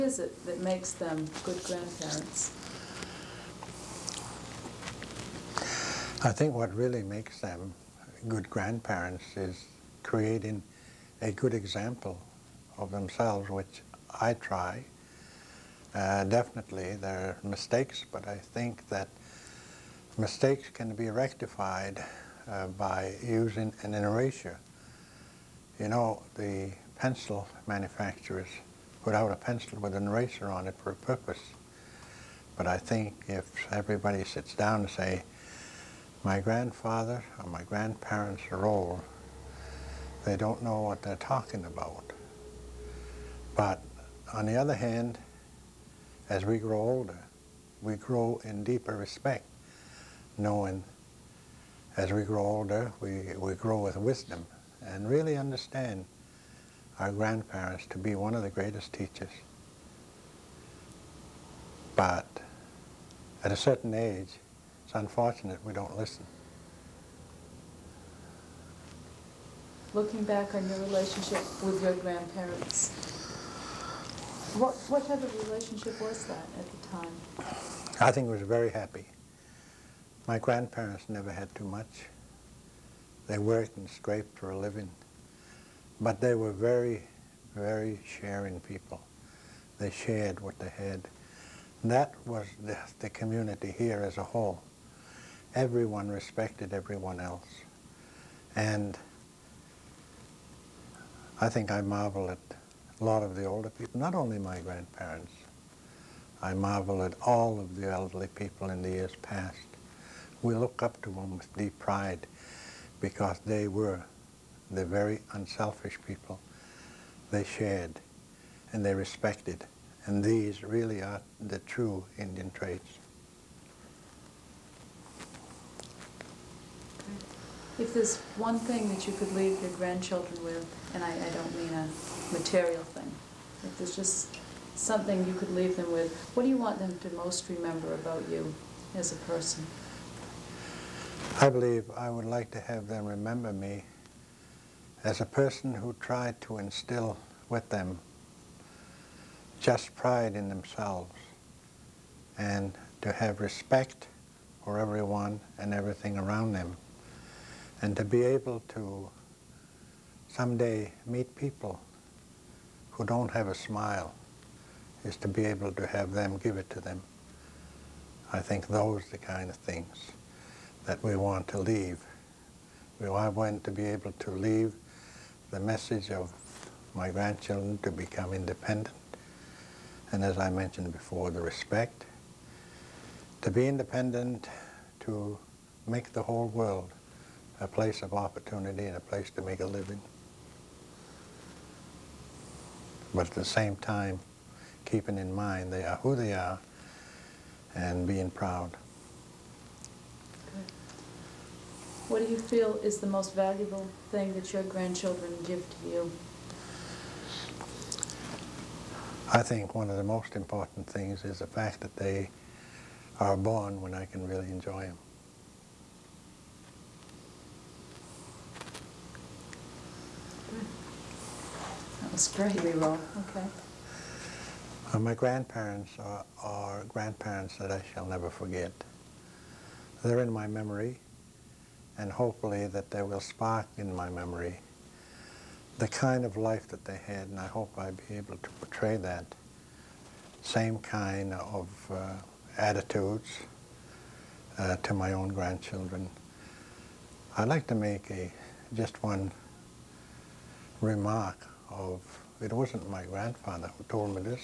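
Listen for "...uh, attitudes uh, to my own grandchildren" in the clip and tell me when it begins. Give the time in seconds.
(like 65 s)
241 s.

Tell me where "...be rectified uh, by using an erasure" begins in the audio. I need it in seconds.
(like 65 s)
20 s.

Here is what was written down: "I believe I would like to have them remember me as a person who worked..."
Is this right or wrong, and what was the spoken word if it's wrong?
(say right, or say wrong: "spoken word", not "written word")
wrong: "tried", not "worked".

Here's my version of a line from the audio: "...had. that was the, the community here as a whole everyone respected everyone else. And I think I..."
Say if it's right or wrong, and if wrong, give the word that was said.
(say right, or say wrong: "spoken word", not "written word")
right.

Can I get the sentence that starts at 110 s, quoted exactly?
We look up to them with deep pride because they were the very unselfish people.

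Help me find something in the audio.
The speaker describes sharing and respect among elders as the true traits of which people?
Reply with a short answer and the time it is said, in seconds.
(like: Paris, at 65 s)
Indian, at 122 s.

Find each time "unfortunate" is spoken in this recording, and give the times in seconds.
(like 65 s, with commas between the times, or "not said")
64 s.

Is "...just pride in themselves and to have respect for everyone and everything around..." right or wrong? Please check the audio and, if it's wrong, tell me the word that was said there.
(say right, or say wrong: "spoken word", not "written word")
right.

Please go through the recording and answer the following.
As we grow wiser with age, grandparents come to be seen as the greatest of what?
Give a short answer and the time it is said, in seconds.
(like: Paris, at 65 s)
Teachers, at 58 s.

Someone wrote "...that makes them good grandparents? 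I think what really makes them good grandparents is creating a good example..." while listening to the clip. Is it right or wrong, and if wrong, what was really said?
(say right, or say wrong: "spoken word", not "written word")
right.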